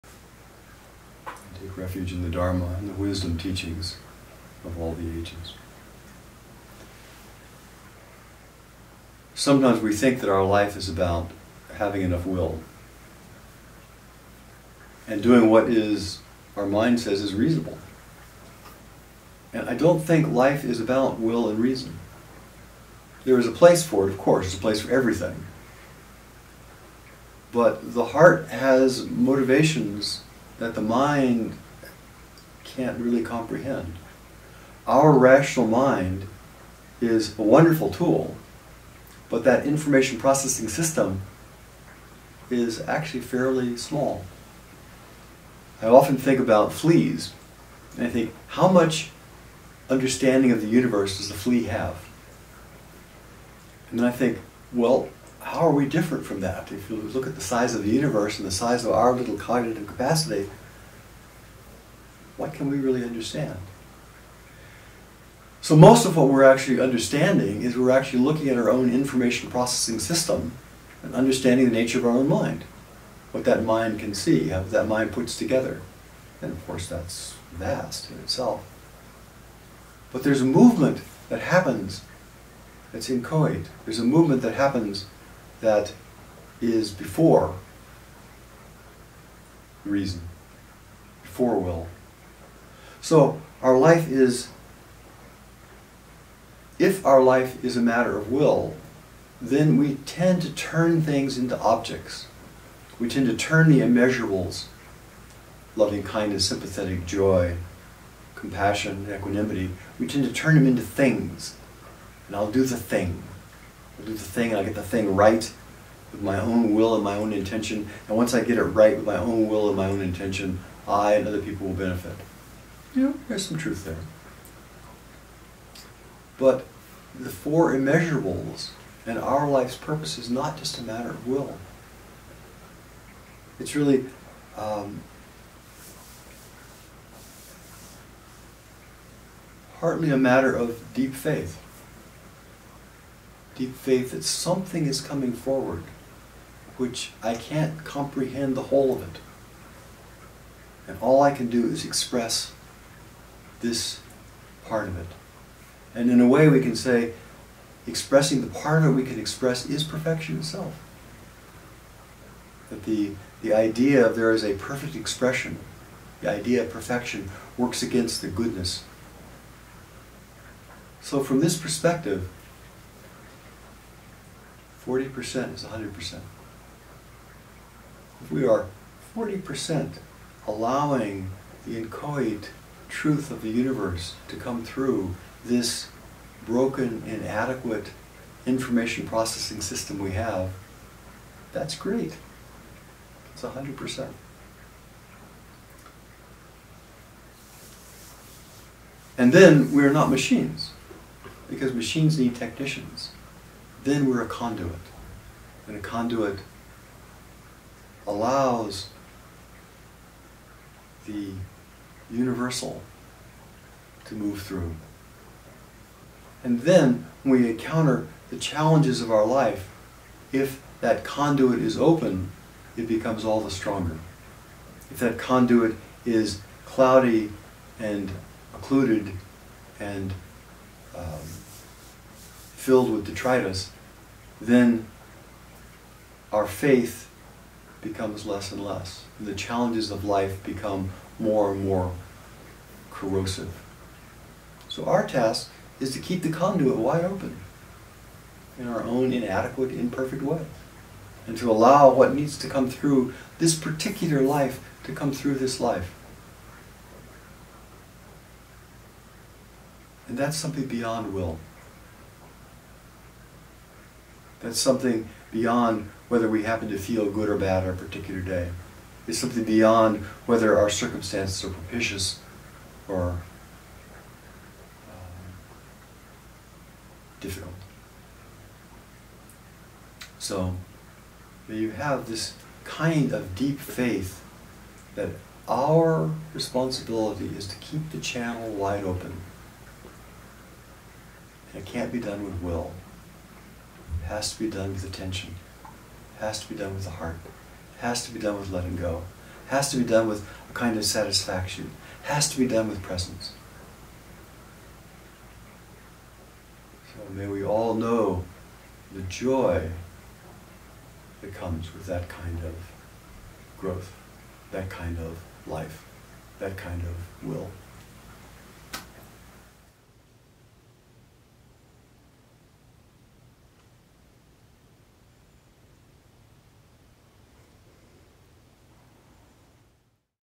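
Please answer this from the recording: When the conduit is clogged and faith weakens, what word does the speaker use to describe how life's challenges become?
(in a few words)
corrosive.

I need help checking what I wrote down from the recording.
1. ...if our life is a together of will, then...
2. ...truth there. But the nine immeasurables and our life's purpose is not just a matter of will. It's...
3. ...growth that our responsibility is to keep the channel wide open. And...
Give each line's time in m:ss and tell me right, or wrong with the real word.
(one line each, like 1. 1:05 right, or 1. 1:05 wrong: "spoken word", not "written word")
1. 1:36 wrong: "matter", not "together"
2. 2:03 wrong: "four", not "nine"
3. 4:43 wrong: "faith", not "growth".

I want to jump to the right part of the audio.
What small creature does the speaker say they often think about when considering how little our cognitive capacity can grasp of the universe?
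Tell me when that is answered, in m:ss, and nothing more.
0:46.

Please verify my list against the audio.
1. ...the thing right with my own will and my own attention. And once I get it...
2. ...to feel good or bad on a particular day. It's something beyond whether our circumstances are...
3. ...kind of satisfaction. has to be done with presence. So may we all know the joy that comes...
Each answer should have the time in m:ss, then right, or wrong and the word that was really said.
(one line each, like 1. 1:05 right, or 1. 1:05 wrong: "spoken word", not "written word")
1. 1:54 wrong: "intention", not "attention"
2. 4:26 right
3. 5:00 right.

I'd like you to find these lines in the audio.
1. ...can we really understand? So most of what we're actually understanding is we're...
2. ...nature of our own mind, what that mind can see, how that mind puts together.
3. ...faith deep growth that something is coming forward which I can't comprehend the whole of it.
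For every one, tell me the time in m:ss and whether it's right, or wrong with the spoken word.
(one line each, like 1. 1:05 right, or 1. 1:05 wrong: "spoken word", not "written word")
1. 1:02 right
2. 1:11 right
3. 2:21 wrong: "faith", not "growth".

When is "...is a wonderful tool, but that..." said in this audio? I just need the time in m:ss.
0:37.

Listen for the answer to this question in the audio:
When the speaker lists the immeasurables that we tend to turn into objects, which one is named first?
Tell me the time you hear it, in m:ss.
1:45.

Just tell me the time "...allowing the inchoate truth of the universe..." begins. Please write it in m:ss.
3:00.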